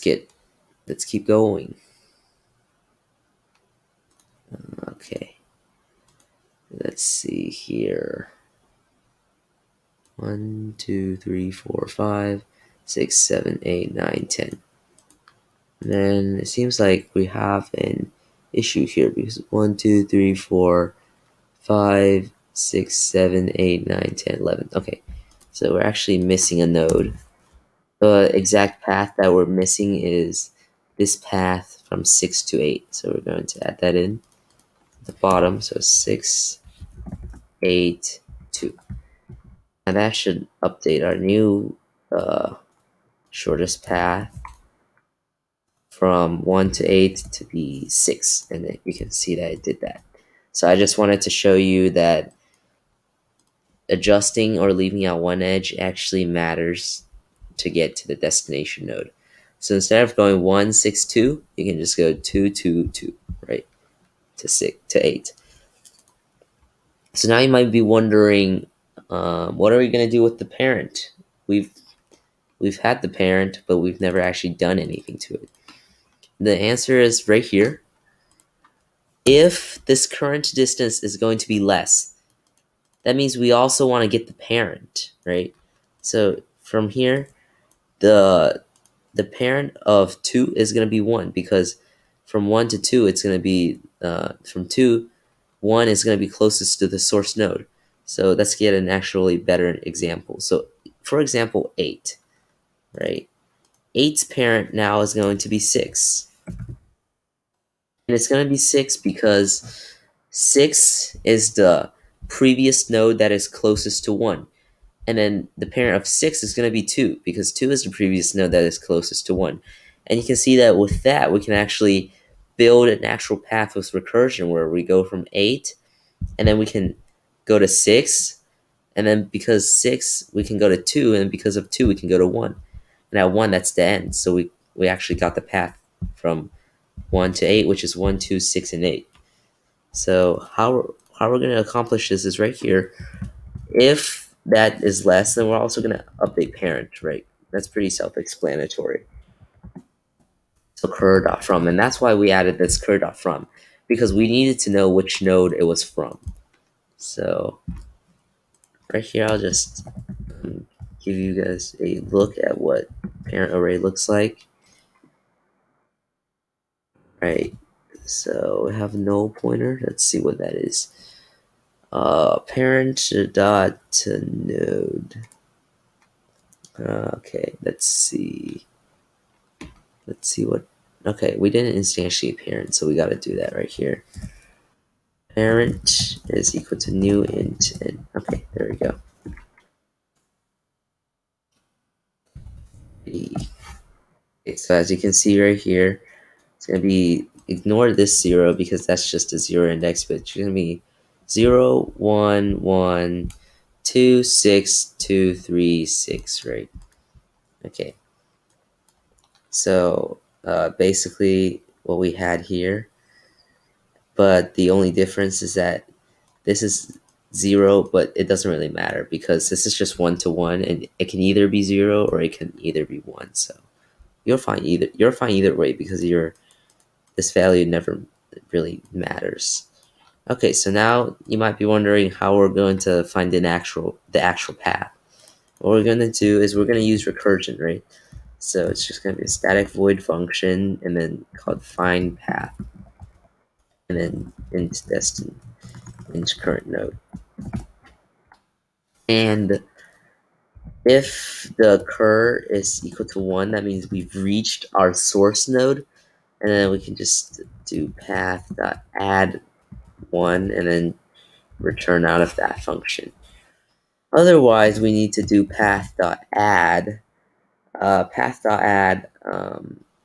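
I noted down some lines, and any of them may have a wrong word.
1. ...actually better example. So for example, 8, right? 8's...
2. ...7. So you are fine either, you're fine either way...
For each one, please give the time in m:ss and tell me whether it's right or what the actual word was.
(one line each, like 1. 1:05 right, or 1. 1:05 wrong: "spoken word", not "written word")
1. 1:38 right
2. 3:42 wrong: "1", not "7".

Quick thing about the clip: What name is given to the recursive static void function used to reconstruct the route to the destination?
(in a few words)
find path.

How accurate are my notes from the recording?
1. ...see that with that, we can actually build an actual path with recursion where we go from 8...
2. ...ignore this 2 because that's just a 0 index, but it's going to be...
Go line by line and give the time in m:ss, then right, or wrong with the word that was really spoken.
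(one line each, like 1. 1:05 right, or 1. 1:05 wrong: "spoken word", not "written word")
1. 2:00 right
2. 3:17 wrong: "0", not "2".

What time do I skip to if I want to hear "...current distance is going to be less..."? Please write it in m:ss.
1:20.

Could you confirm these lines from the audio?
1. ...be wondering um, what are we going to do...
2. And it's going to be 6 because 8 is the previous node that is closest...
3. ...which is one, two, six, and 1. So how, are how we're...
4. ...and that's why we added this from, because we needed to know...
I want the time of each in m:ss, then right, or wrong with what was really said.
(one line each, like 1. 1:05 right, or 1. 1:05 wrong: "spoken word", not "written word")
1. 1:07 right
2. 1:48 wrong: "6", not "8"
3. 2:17 wrong: "8", not "1"
4. 2:31 right.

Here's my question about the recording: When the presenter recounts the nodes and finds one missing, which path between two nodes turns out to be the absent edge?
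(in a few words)
6 to 8.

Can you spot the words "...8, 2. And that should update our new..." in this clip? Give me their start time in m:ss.
0:37.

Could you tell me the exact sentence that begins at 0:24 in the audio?
Okay, so we're actually missing a node.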